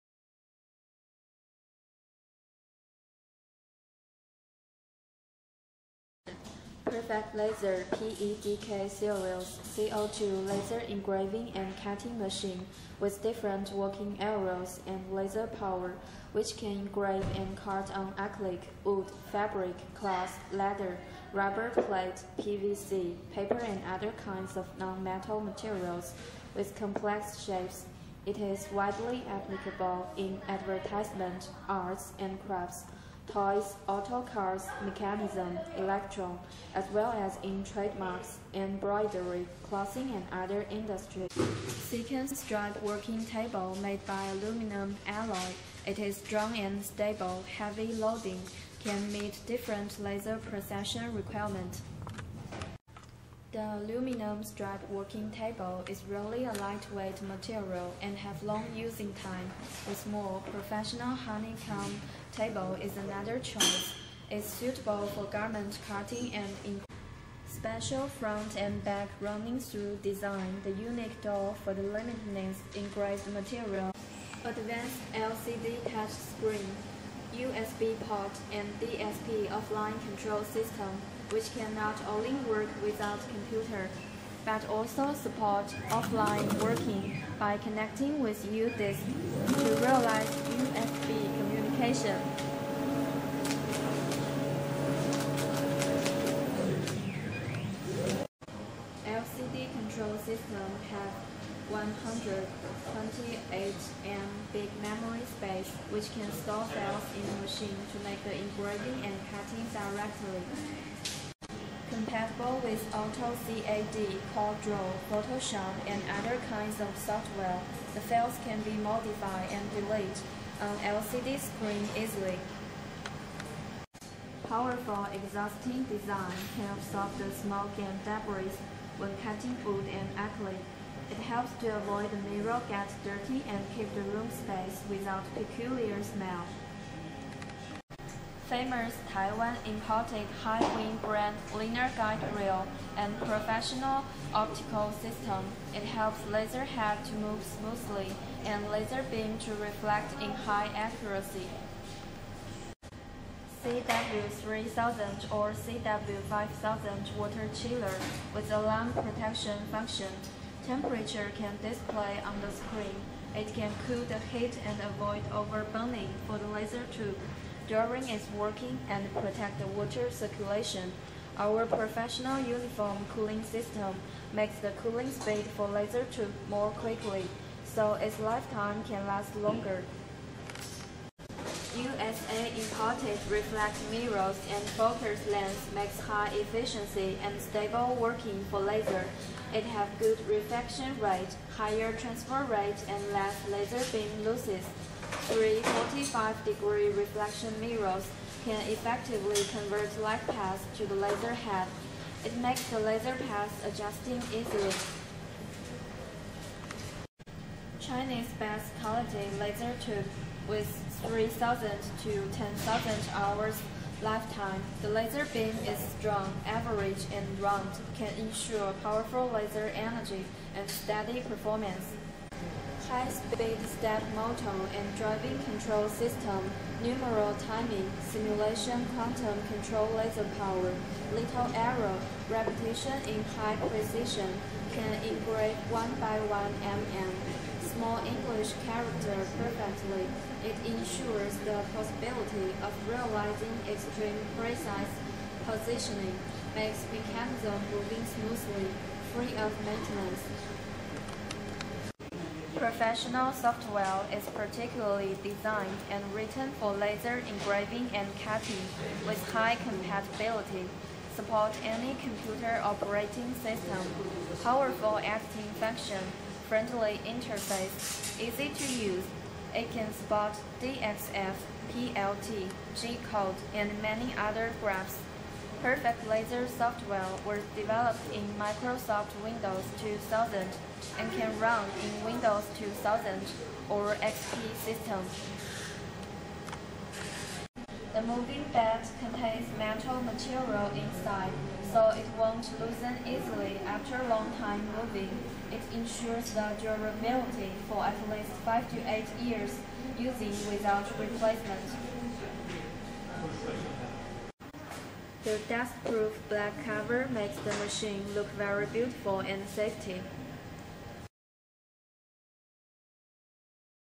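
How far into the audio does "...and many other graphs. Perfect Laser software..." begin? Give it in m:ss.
4:33.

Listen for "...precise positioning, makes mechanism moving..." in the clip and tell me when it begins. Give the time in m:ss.
4:04.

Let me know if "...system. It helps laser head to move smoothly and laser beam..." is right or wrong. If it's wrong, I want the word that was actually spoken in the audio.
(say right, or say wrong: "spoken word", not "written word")
right.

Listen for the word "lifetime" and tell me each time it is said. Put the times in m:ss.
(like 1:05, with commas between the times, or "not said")
2:58, 3:34.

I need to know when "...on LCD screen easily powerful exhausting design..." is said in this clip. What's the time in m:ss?
2:00.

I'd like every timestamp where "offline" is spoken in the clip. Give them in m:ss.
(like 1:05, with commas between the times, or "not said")
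1:19, 1:25.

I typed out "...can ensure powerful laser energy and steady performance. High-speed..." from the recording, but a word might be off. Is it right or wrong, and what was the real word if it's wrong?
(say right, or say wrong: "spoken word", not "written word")
right.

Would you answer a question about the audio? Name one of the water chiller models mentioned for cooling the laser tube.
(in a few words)
CW3000.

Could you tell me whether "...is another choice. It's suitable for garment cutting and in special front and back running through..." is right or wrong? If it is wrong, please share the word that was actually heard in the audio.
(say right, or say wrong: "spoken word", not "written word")
right.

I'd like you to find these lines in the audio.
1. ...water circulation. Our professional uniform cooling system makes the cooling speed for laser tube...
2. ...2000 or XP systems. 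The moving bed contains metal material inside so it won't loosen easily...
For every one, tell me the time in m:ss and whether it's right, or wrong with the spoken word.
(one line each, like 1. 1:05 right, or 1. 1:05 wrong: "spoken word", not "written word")
1. 2:49 right
2. 4:42 right.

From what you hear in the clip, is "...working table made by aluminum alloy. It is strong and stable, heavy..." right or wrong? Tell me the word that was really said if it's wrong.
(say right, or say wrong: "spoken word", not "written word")
right.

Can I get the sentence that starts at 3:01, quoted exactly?
USA imported reflect mirrors and focus lens makes high efficiency and stable working for laser.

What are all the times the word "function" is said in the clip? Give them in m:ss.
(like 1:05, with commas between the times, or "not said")
2:39, 4:25.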